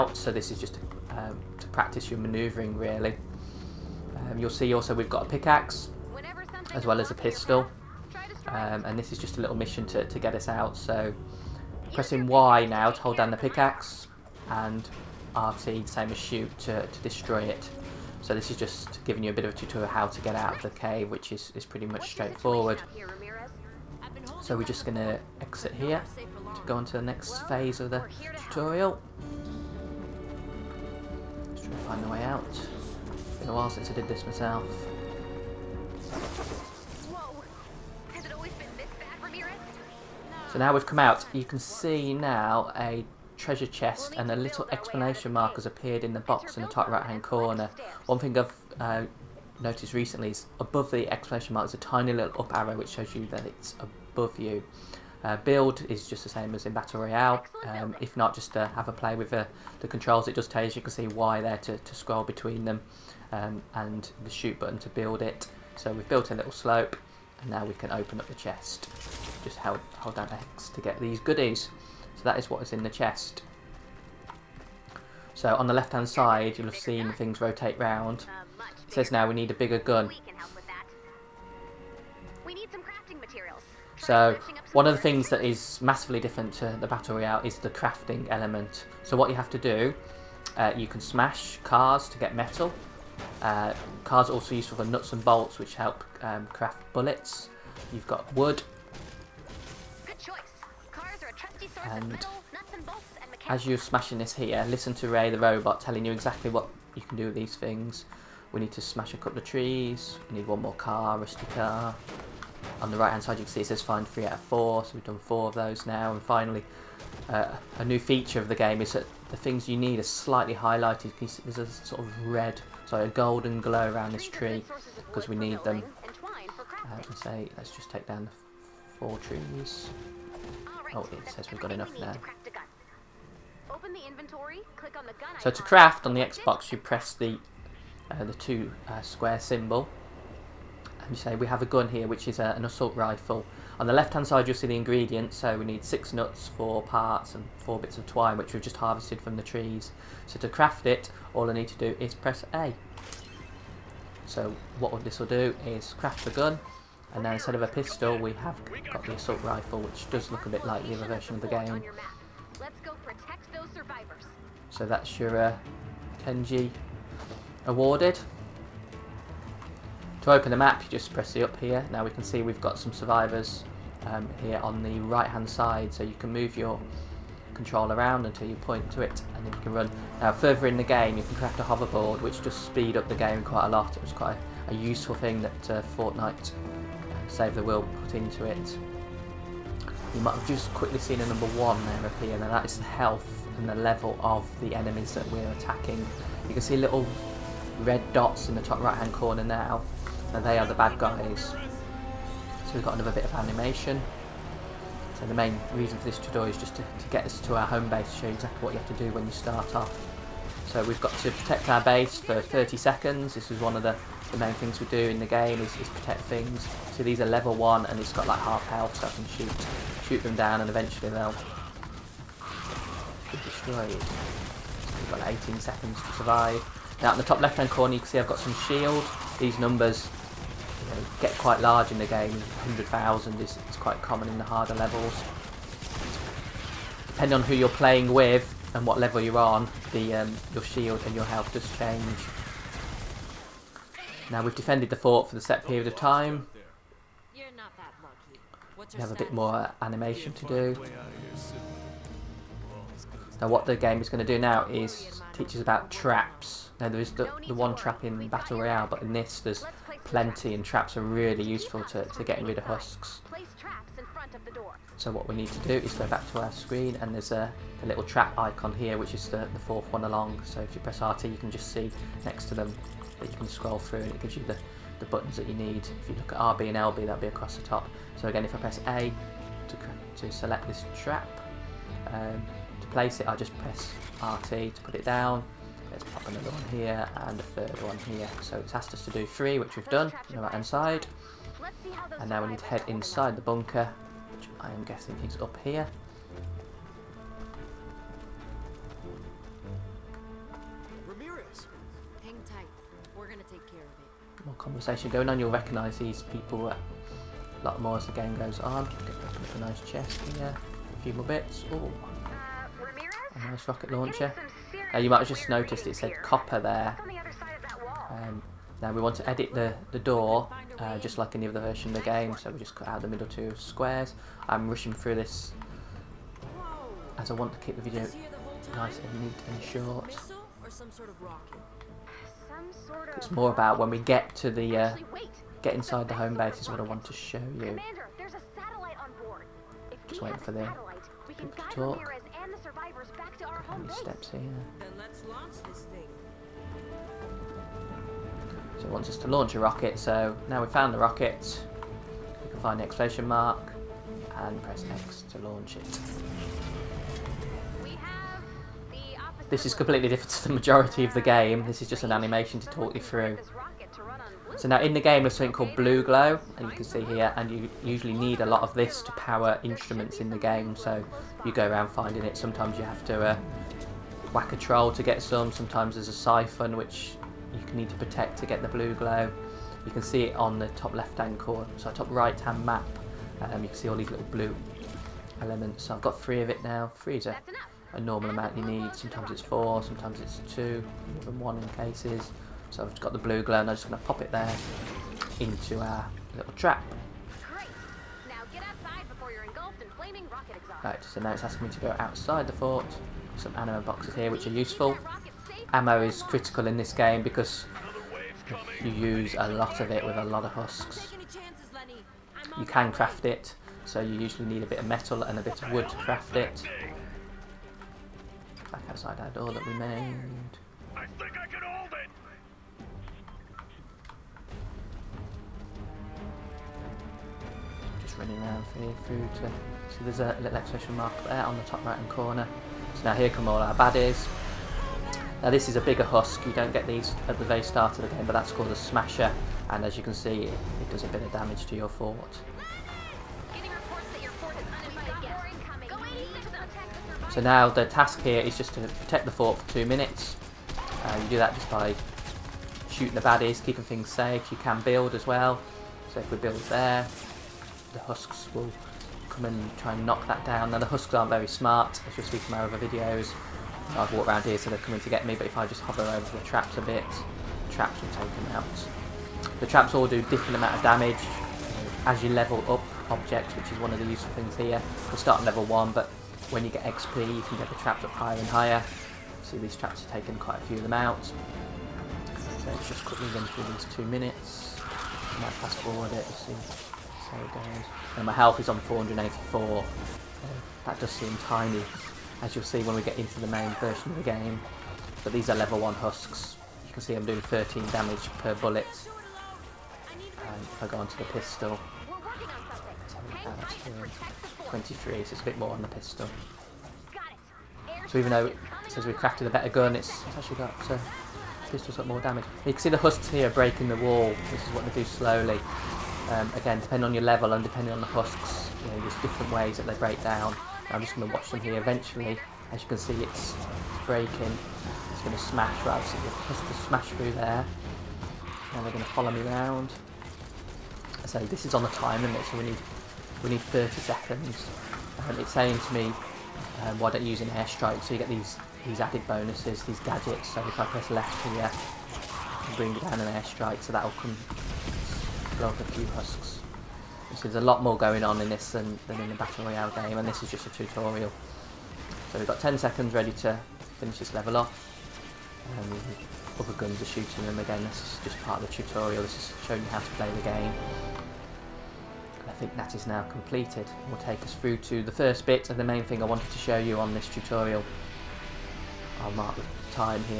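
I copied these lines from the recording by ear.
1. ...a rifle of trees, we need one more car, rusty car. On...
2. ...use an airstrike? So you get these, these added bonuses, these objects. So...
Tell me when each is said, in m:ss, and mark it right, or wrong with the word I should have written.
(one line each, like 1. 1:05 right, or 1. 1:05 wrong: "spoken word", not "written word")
1. 1:49 wrong: "couple", not "rifle"
2. 8:57 wrong: "gadgets", not "objects".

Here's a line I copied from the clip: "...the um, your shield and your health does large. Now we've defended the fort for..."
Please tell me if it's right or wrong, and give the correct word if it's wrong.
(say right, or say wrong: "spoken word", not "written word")
wrong: "change", not "large".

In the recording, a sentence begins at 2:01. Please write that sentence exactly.
There's a sort of red, sorry, a golden glow around this tree because we need them.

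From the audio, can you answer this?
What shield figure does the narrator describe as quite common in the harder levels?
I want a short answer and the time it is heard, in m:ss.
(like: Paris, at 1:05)
100,000, at 3:52.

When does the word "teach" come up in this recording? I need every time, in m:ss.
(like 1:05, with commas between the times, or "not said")
4:15.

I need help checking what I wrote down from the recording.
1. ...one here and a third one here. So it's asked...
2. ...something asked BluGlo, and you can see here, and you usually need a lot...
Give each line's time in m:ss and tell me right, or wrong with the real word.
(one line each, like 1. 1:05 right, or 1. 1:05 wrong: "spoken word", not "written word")
1. 4:46 right
2. 6:05 wrong: "called", not "asked".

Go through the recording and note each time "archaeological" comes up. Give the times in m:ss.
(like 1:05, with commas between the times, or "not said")
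not said.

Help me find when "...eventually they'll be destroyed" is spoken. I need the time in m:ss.
3:40.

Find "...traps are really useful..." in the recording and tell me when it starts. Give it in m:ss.
4:20.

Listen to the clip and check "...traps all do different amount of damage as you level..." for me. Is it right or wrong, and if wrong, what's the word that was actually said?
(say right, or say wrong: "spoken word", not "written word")
right.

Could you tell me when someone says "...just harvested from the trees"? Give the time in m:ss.
2:28.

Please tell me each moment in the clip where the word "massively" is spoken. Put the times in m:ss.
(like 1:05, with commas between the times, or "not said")
1:25.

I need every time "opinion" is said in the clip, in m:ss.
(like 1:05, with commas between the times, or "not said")
not said.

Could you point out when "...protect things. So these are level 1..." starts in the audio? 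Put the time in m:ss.
3:35.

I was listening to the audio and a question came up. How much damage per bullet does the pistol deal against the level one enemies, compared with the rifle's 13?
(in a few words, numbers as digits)
23.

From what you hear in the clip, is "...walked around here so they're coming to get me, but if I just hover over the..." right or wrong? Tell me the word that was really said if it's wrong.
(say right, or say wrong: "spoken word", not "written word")
right.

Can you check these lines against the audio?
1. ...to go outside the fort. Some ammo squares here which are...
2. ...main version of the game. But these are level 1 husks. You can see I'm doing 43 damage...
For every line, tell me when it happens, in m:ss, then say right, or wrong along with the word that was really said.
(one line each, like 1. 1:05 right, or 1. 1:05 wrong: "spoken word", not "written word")
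1. 6:41 wrong: "boxes", not "squares"
2. 8:13 wrong: "13", not "43".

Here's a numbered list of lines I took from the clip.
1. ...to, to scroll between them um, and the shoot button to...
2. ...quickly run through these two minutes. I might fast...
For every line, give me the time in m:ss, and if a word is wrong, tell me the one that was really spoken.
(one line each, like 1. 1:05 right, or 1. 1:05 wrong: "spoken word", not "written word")
1. 1:01 right
2. 8:03 right.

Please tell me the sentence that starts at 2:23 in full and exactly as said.
On the left-hand side, you'll see the ingredients.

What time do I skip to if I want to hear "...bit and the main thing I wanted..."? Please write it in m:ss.
9:25.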